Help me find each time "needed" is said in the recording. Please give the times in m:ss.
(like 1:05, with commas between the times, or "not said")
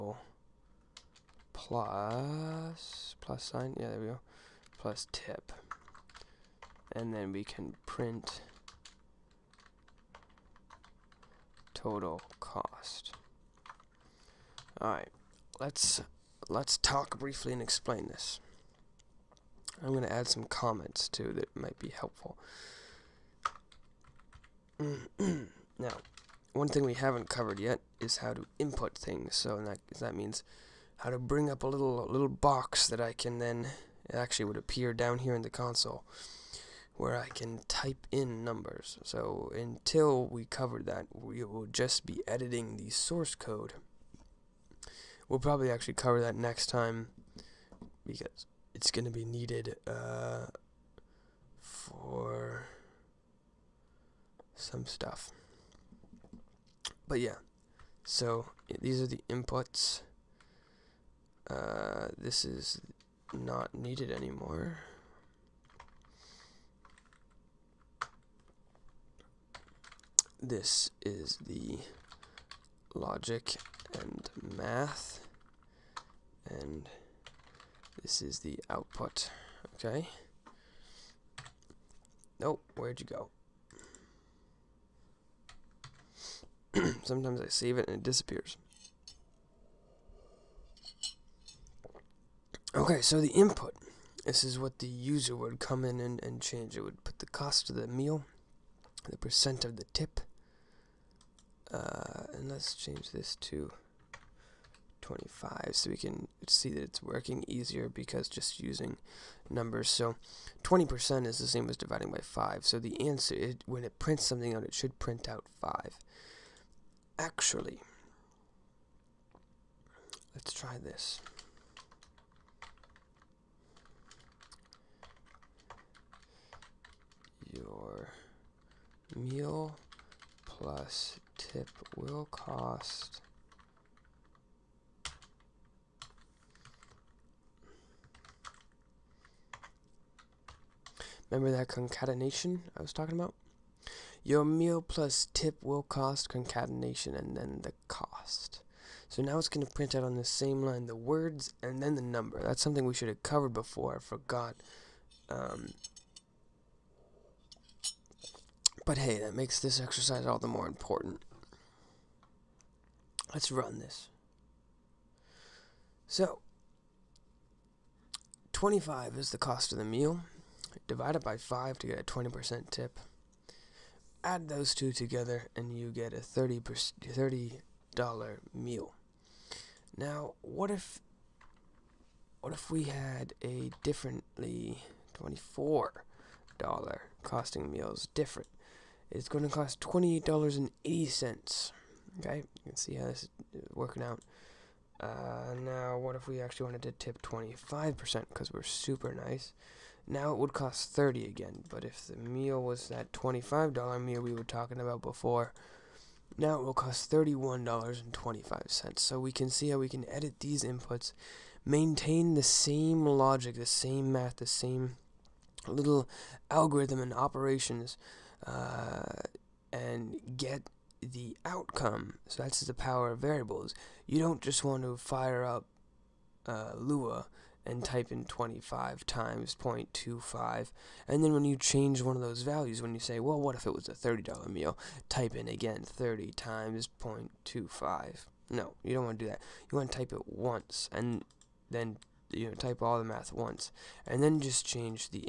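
0:49, 1:03.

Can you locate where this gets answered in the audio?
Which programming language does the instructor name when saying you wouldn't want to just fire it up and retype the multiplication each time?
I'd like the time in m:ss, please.
3:46.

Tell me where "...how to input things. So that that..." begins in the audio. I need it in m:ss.
0:28.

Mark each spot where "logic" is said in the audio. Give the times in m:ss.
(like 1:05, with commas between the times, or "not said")
1:12, 3:33.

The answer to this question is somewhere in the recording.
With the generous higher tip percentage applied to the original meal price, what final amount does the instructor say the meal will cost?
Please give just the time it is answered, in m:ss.
3:27.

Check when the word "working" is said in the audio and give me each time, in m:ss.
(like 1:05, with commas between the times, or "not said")
1:47, 3:13.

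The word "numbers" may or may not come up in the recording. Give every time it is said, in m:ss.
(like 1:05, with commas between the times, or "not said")
0:38, 1:49, 2:32.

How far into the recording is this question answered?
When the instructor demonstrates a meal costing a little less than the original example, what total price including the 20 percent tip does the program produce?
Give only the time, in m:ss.
3:09.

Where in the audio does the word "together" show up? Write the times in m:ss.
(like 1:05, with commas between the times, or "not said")
2:54.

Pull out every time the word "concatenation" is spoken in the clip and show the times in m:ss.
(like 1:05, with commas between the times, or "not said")
2:21, 2:26.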